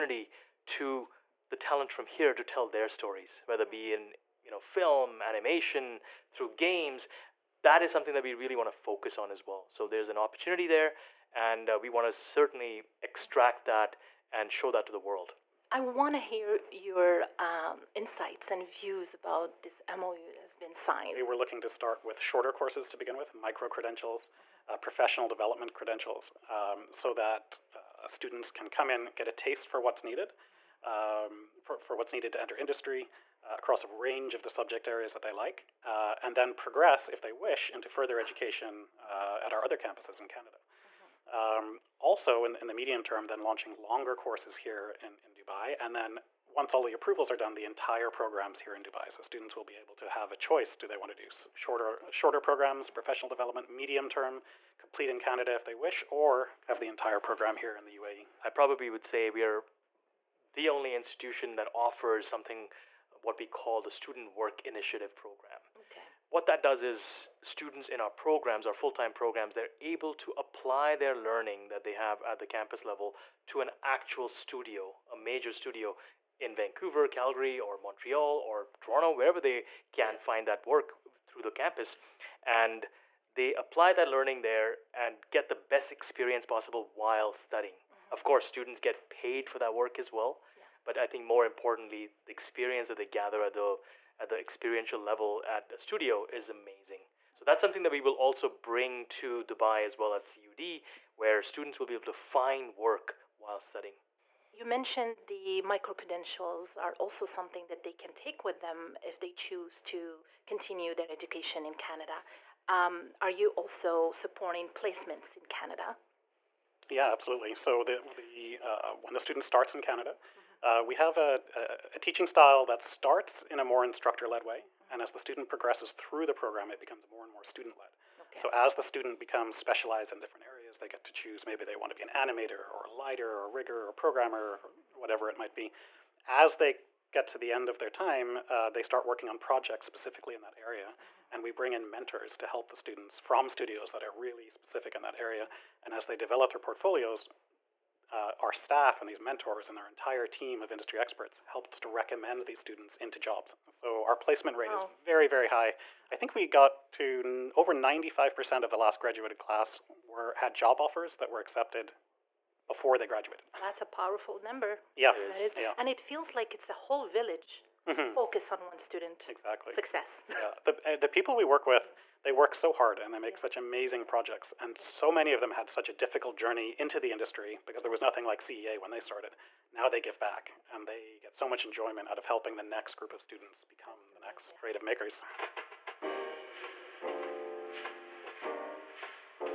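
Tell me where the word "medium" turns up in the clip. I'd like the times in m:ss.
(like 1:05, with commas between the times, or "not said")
0:42, 0:53.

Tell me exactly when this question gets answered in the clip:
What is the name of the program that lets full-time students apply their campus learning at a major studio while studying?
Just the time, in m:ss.
1:03.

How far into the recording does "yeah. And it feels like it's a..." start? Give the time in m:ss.
2:45.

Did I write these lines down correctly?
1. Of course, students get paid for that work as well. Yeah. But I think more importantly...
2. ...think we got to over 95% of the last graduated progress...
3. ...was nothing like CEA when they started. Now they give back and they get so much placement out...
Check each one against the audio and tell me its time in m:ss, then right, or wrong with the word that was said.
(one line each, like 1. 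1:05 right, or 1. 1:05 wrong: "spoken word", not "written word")
1. 1:28 right
2. 2:36 wrong: "class", not "progress"
3. 2:57 wrong: "enjoyment", not "placement".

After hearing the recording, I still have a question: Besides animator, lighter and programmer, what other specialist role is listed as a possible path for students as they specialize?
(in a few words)
Rigger.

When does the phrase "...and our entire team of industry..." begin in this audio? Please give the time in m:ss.
2:29.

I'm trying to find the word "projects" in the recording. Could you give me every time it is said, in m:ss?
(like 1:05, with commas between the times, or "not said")
2:19, 2:54.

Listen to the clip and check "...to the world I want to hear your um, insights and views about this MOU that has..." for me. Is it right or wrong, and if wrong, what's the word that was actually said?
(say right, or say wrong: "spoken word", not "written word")
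right.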